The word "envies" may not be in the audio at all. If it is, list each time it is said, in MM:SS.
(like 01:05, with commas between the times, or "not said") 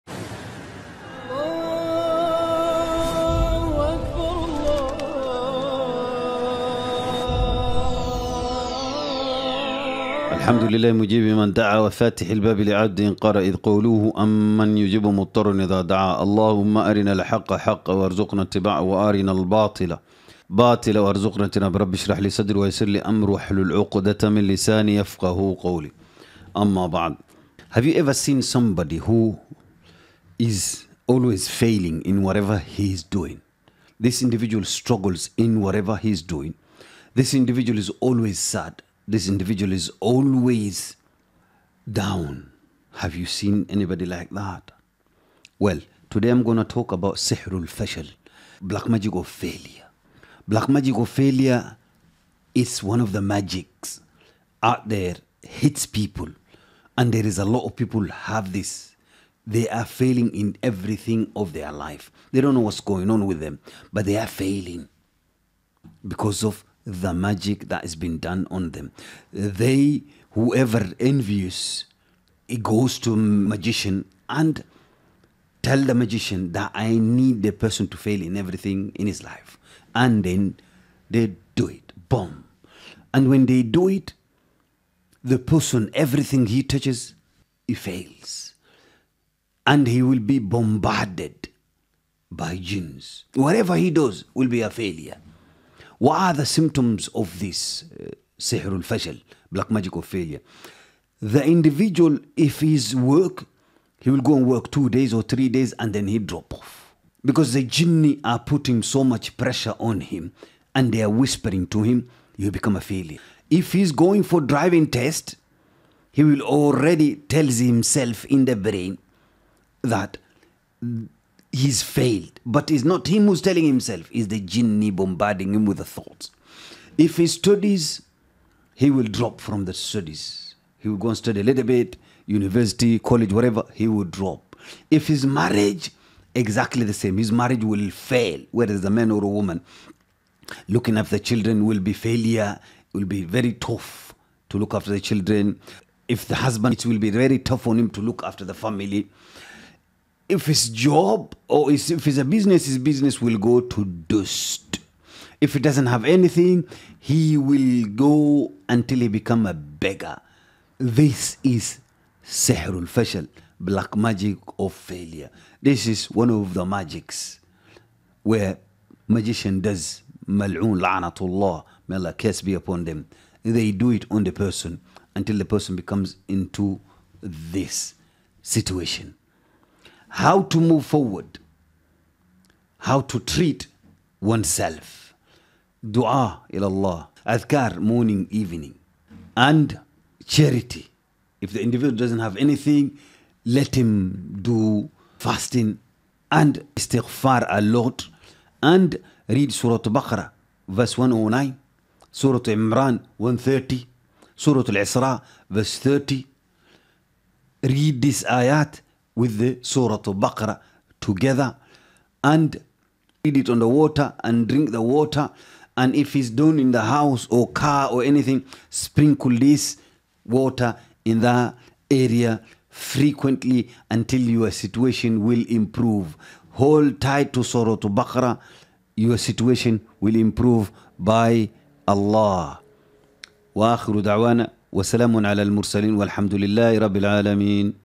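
01:10.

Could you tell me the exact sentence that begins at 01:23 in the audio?
And when they do it, the person, everything he touches, he fails.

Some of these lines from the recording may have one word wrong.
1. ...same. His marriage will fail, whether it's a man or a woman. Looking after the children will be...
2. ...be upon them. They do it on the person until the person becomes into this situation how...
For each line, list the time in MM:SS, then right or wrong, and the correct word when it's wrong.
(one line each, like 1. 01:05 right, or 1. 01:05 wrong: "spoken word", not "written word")
1. 02:16 right
2. 02:52 right.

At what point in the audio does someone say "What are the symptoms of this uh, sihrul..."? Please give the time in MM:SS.
01:36.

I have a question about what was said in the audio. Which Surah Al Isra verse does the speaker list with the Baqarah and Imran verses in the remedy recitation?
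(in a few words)
30.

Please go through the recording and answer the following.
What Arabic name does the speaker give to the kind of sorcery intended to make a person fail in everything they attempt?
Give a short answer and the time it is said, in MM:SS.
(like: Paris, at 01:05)
Sihrul Fashal, at 00:47.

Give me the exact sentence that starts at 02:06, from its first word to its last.
If he studies, he will drop from the studies.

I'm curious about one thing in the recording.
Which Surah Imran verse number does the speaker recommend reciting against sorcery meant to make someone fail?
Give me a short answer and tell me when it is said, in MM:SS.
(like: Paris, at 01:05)
130, at 03:23.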